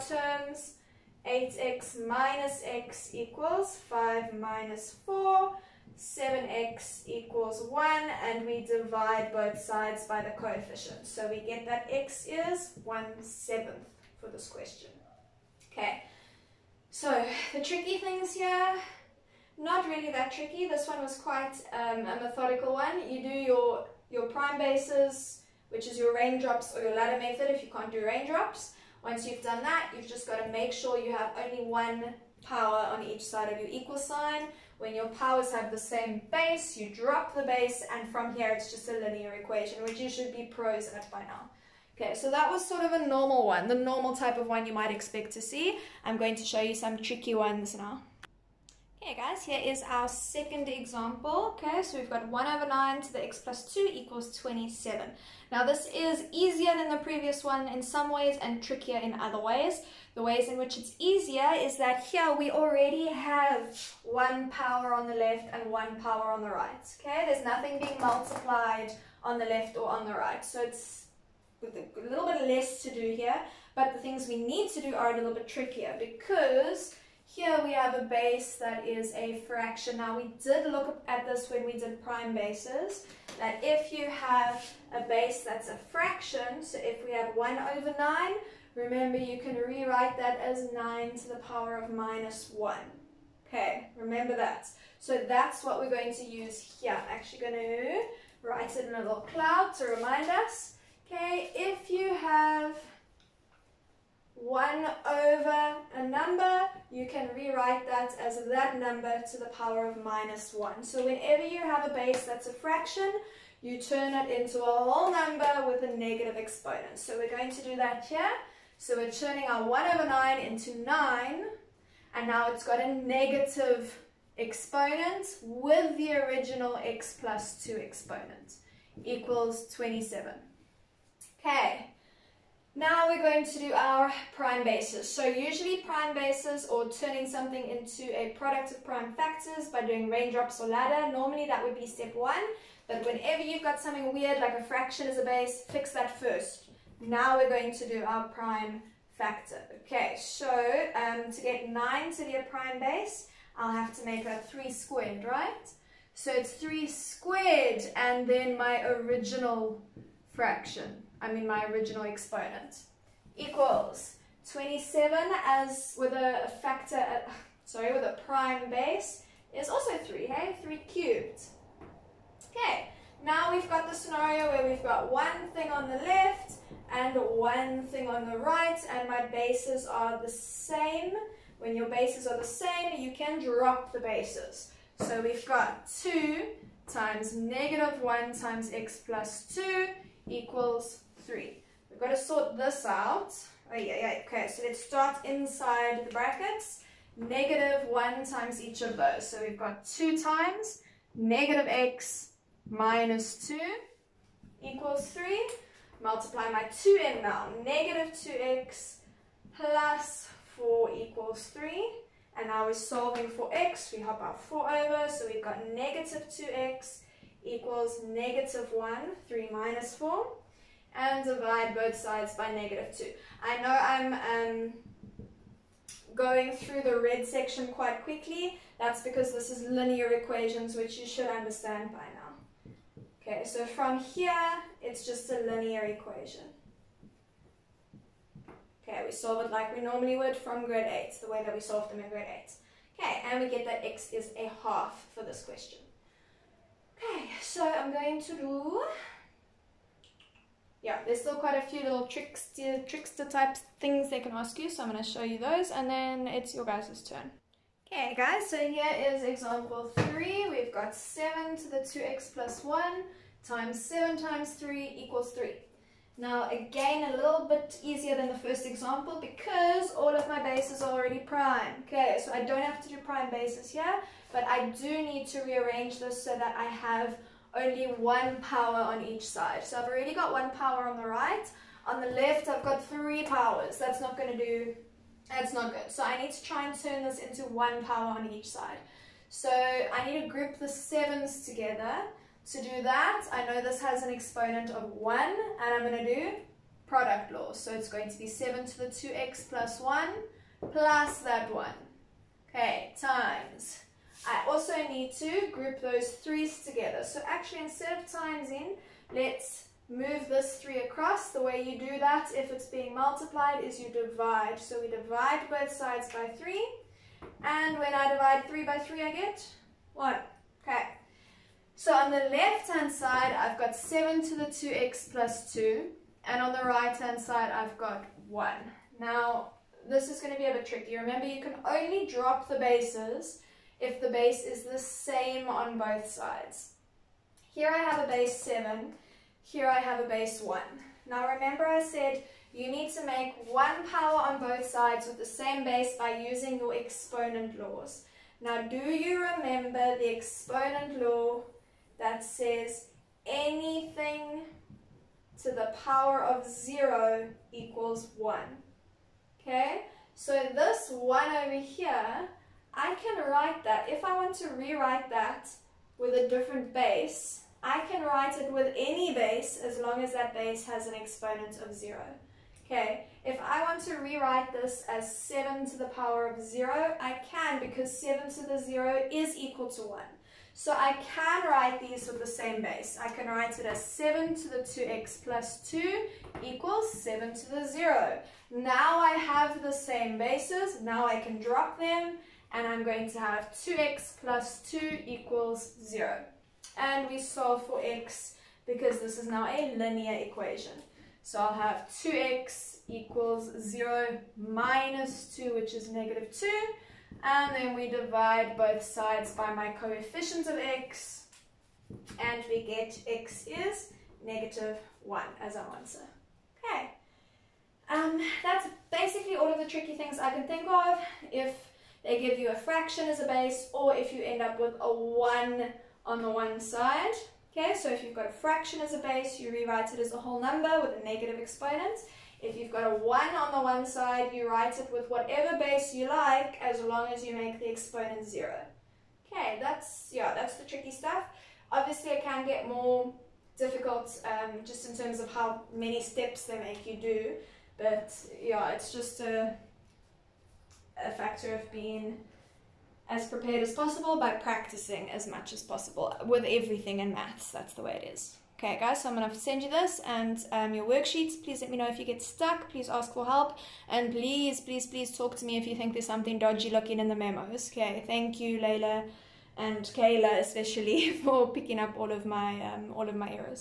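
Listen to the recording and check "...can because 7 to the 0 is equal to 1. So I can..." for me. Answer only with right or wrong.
right.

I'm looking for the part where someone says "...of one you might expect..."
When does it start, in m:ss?
0:44.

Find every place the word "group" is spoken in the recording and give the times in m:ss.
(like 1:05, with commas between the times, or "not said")
4:50, 5:05.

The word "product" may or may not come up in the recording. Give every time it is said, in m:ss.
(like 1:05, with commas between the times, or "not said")
2:18, 4:56.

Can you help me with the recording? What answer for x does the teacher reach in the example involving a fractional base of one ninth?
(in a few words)
1/2.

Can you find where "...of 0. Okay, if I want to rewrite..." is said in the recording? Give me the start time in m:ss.
6:11.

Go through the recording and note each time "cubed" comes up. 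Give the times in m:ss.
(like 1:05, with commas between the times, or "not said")
2:50.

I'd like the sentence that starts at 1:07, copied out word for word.
Okay, there's nothing being multiplied on the left or on the right.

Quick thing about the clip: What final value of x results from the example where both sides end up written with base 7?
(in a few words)
-1.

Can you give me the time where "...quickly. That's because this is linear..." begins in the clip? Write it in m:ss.
3:48.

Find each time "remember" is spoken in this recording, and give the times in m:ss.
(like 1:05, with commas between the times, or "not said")
1:28, 1:33, 5:30, 5:41, 5:49.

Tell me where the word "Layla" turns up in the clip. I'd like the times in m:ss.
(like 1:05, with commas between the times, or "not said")
7:48.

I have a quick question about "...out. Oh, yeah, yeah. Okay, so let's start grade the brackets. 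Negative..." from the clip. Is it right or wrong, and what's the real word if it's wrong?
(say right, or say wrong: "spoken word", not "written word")
wrong: "inside", not "grade".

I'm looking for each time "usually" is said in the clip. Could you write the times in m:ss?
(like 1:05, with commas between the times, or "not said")
2:15.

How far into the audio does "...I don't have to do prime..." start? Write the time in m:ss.
4:32.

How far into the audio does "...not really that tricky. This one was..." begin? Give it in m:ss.
0:19.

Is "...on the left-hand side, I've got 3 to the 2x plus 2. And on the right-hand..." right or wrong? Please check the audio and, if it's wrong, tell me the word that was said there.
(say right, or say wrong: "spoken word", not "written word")
wrong: "7", not "3".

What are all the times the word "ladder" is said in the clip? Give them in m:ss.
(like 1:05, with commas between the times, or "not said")
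0:26, 2:20.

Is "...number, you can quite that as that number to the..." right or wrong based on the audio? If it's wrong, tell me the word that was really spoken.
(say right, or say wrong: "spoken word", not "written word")
wrong: "rewrite", not "quite".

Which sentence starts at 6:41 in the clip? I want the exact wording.
So I'll have 2x equals 0 minus 2, which is negative 2.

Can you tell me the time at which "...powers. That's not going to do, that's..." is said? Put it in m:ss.
4:43.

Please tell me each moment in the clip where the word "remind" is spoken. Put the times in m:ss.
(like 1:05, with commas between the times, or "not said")
1:39.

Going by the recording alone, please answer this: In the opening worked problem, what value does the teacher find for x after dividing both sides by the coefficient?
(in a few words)
1/7.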